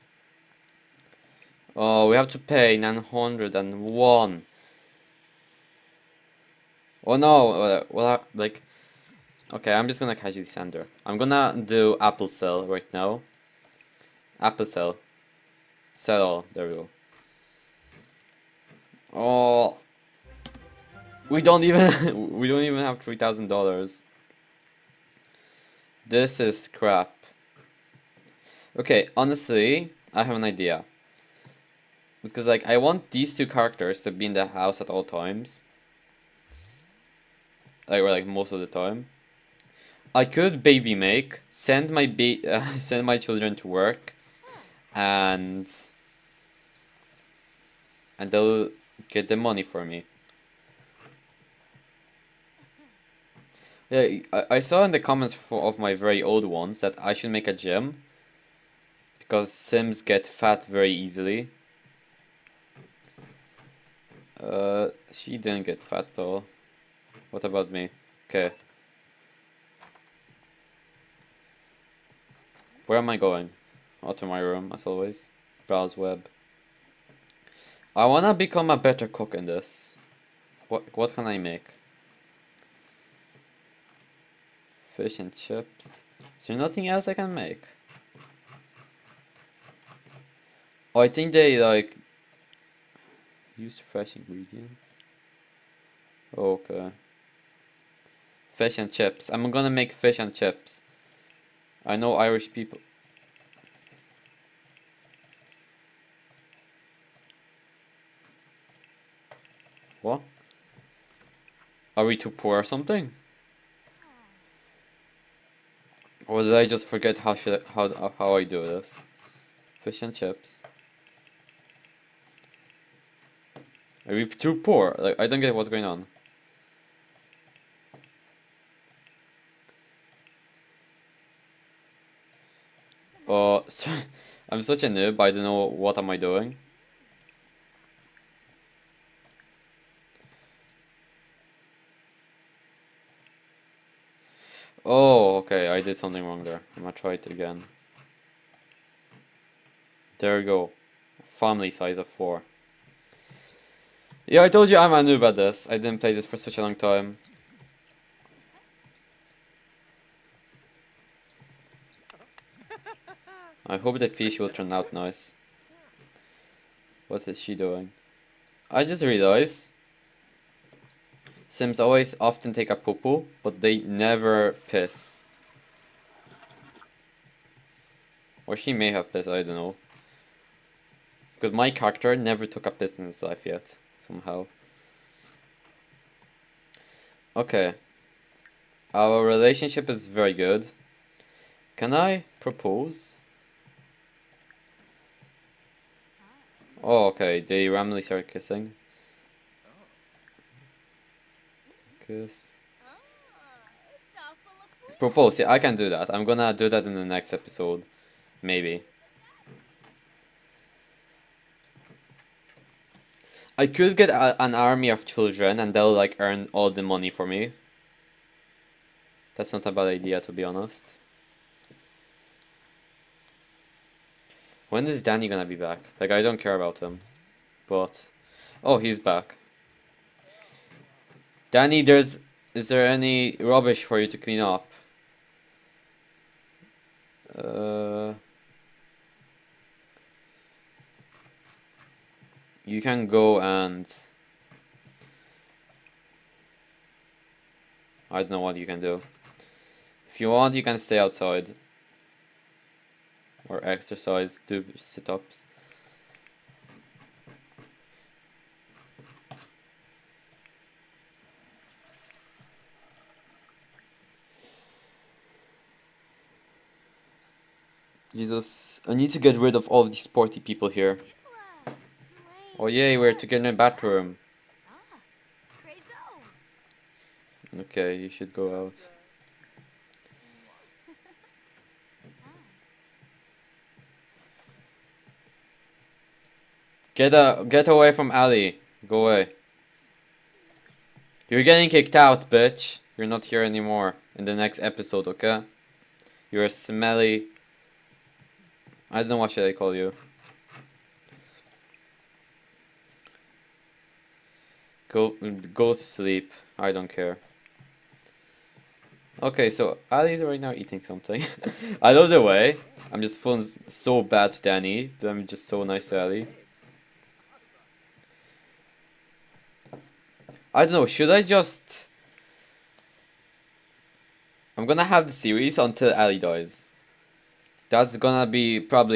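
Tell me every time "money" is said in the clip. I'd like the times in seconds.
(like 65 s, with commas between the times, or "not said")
49 s, 216 s.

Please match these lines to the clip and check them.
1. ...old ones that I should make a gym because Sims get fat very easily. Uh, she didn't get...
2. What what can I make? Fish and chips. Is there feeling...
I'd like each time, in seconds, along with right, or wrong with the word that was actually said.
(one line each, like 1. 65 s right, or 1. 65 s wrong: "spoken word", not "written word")
1. 56 s right
2. 80 s wrong: "nothing", not "feeling".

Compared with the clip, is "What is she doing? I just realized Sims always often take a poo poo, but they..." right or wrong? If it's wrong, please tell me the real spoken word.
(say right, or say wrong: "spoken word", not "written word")
right.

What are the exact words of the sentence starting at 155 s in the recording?
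I didn't play this for such a long time.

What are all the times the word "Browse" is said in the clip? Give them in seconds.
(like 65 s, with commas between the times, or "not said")
75 s.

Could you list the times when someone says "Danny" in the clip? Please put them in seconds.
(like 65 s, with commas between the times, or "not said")
225 s, 231 s, 314 s.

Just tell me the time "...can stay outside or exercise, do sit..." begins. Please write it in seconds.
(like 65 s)
250 s.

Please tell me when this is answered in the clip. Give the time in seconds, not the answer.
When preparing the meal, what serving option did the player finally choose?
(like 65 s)
151 s.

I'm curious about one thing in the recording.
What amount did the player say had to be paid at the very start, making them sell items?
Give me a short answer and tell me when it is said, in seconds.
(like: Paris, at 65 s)
901, at 2 s.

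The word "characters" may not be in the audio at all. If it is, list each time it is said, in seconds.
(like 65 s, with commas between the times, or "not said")
33 s, 181 s.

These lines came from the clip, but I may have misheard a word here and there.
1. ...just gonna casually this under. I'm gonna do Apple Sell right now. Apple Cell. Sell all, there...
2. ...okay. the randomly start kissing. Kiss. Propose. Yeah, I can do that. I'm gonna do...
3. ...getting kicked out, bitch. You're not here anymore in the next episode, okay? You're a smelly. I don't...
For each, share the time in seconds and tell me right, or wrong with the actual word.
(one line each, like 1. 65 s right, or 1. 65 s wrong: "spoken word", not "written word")
1. 9 s right
2. 197 s right
3. 291 s right.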